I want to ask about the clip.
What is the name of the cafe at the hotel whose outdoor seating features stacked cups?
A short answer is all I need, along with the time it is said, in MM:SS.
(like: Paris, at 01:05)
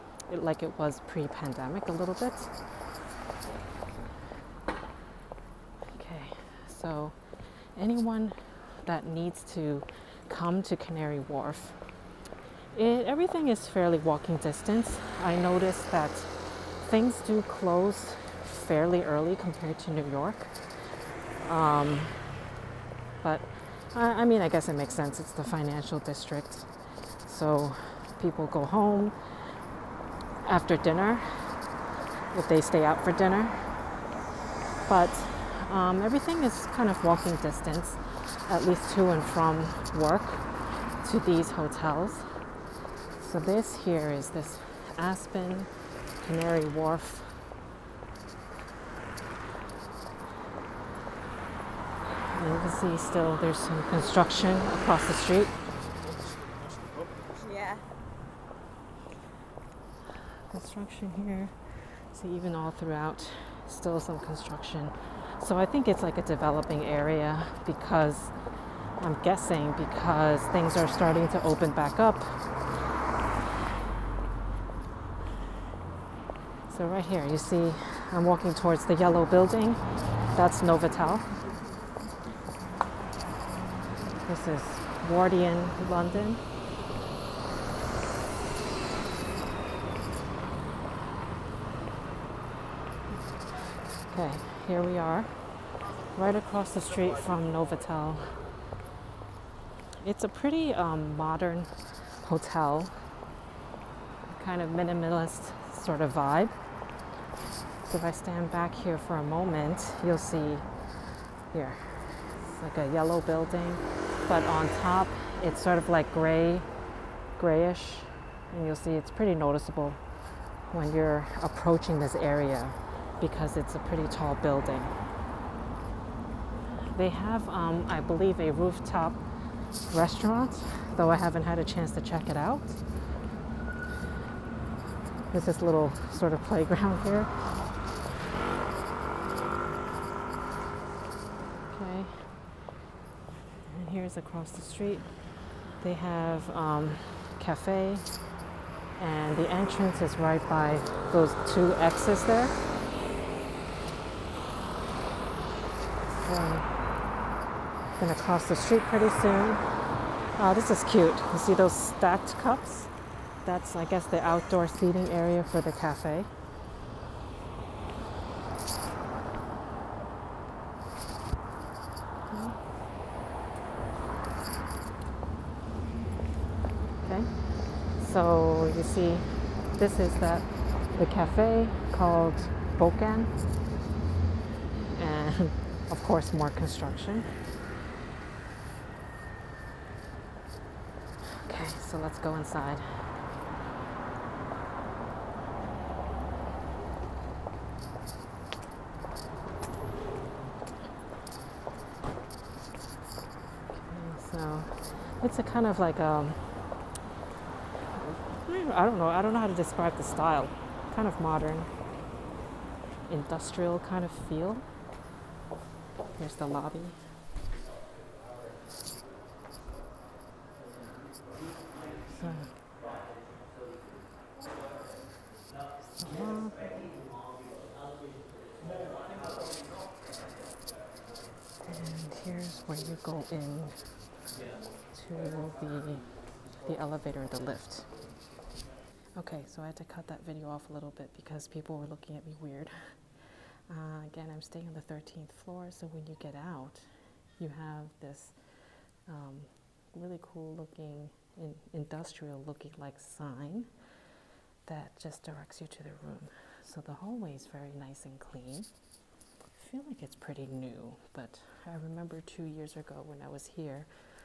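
Bokan, at 03:02.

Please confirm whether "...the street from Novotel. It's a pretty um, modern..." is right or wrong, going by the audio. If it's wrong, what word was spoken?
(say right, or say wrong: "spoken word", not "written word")
right.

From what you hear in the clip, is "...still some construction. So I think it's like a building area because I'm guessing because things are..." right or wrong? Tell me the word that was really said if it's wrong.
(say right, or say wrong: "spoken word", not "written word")
wrong: "developing", not "building".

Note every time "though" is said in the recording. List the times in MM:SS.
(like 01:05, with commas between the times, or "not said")
02:10.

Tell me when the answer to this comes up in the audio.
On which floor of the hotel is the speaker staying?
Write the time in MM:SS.
04:04.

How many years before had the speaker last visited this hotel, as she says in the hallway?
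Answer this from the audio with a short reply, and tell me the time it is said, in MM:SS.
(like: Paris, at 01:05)
2, at 04:22.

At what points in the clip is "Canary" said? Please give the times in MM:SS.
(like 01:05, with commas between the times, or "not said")
00:10, 00:46.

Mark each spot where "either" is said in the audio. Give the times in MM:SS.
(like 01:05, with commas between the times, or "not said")
not said.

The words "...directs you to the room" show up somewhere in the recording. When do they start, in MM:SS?
04:15.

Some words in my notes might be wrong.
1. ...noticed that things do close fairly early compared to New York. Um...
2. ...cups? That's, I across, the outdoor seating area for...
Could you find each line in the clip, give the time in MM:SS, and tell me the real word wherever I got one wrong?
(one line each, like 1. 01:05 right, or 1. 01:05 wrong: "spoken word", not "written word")
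1. 00:15 right
2. 02:42 wrong: "guess", not "across".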